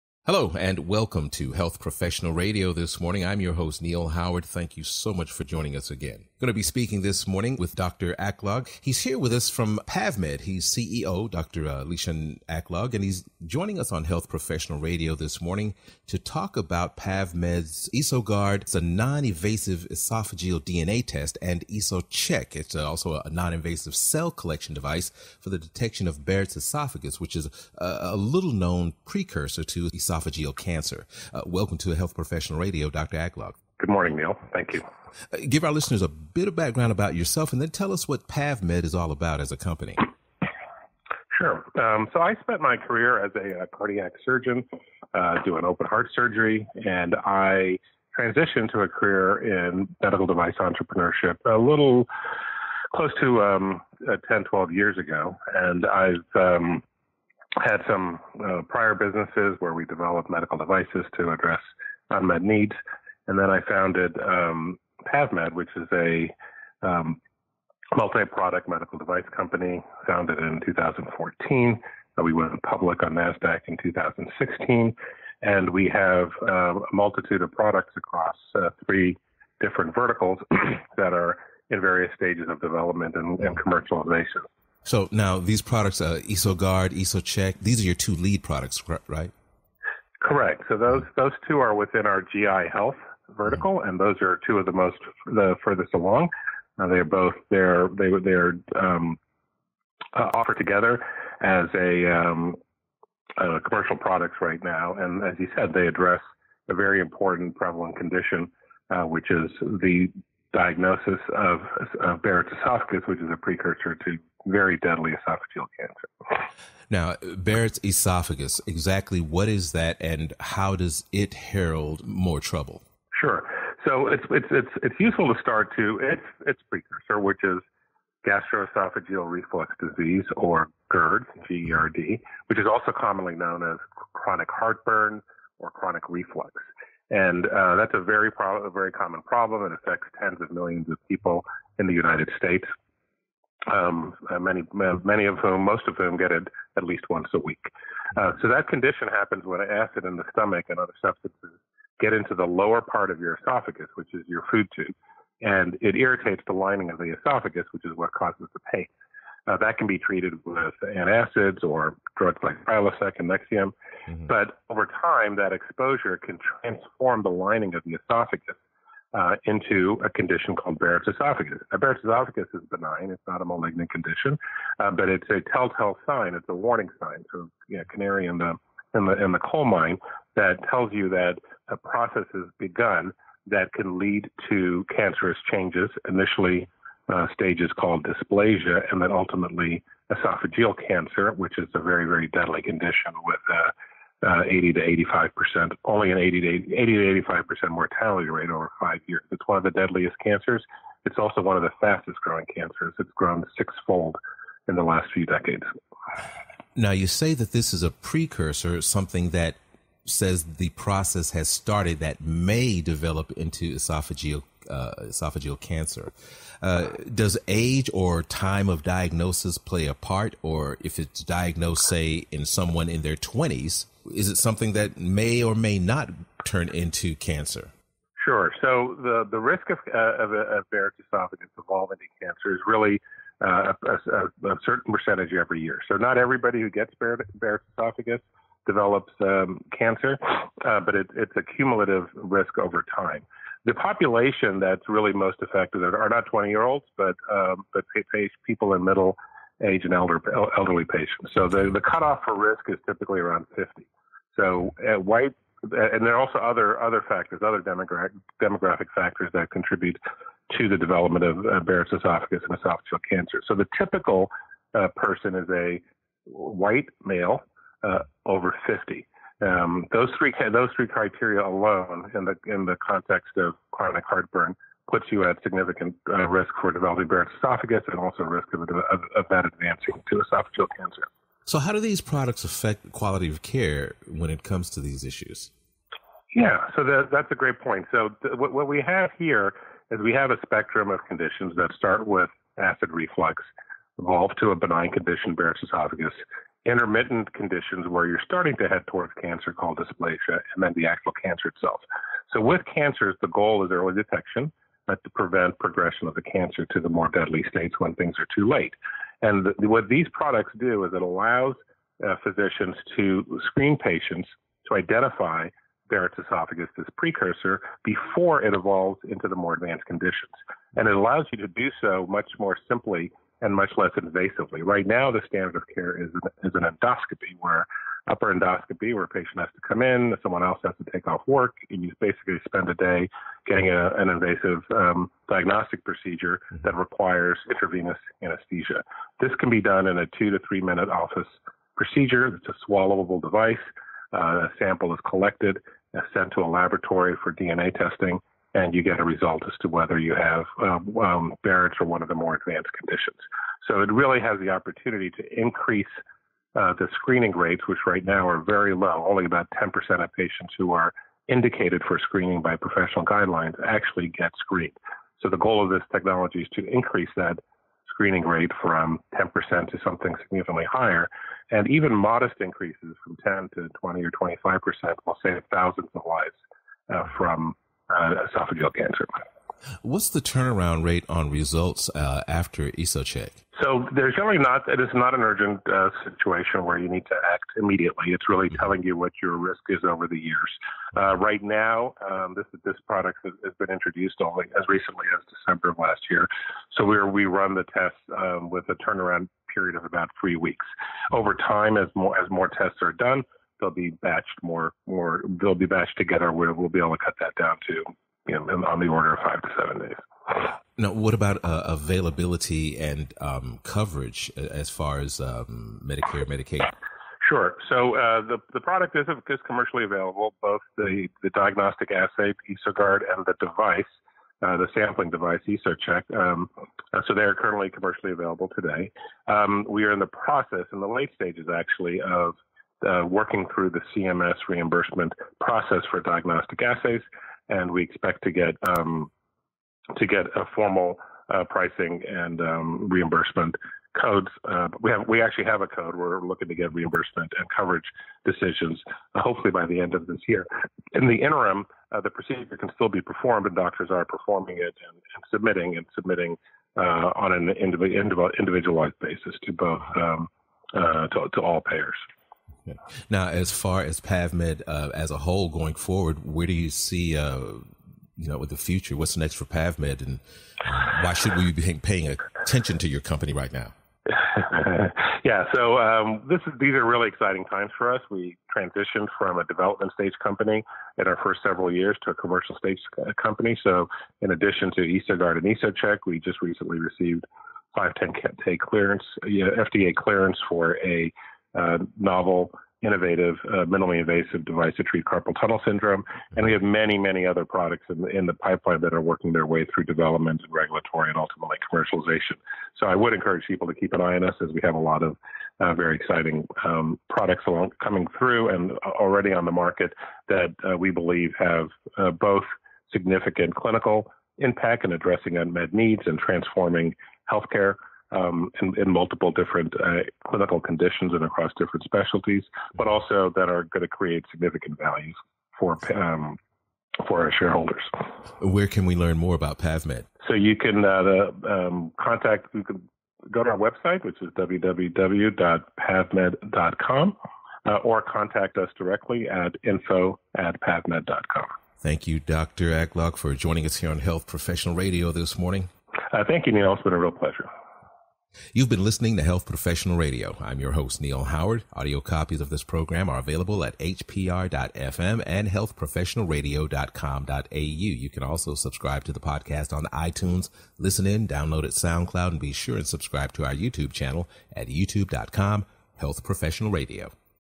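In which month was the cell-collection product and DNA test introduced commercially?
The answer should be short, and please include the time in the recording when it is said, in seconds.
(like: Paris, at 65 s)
December, at 395 s.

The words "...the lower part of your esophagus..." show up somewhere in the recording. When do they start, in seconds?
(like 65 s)
152 s.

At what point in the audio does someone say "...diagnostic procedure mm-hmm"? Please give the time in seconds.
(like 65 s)
335 s.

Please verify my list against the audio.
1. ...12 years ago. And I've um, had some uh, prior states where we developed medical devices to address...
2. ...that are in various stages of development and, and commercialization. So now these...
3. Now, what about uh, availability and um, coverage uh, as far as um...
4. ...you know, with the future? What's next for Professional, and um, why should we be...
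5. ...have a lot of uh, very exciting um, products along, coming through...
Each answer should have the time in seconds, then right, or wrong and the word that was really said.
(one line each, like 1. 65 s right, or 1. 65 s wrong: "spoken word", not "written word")
1. 54 s wrong: "businesses", not "states"
2. 80 s right
3. 410 s right
4. 468 s wrong: "PavMed", not "Professional"
5. 504 s right.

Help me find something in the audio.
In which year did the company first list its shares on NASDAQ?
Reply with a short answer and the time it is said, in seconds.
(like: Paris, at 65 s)
2016, at 73 s.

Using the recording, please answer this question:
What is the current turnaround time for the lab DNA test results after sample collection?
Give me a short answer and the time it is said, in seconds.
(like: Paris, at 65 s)
3 weeks, at 399 s.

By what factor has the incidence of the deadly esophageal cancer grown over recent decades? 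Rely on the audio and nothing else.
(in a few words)
sixfold.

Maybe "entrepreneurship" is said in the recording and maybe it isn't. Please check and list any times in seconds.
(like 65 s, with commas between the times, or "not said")
50 s.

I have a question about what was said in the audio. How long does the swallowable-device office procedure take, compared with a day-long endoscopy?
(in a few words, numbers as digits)
2 to 3 minutes.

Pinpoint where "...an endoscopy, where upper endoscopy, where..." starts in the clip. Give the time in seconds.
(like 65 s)
326 s.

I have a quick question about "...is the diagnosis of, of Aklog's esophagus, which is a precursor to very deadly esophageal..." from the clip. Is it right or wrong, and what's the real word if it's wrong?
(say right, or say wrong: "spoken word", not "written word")
wrong: "Barrett", not "Aklog".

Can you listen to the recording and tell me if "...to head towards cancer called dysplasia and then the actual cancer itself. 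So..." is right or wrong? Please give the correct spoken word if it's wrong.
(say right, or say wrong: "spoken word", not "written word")
right.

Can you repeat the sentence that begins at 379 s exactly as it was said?
What's the turnaround rate on results uh, after EsoCheck?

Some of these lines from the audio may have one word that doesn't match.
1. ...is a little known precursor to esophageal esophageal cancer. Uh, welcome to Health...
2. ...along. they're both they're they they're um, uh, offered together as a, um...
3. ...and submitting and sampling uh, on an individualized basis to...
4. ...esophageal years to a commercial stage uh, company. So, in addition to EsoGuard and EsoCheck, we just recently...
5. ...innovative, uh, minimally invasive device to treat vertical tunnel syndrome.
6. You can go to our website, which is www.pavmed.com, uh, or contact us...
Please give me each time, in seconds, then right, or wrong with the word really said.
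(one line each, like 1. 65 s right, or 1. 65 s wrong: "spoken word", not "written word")
1. 27 s right
2. 95 s right
3. 454 s wrong: "submitting", not "sampling"
4. 481 s wrong: "several", not "esophageal"
5. 492 s wrong: "carpal", not "vertical"
6. 532 s right.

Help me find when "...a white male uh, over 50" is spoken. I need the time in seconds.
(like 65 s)
265 s.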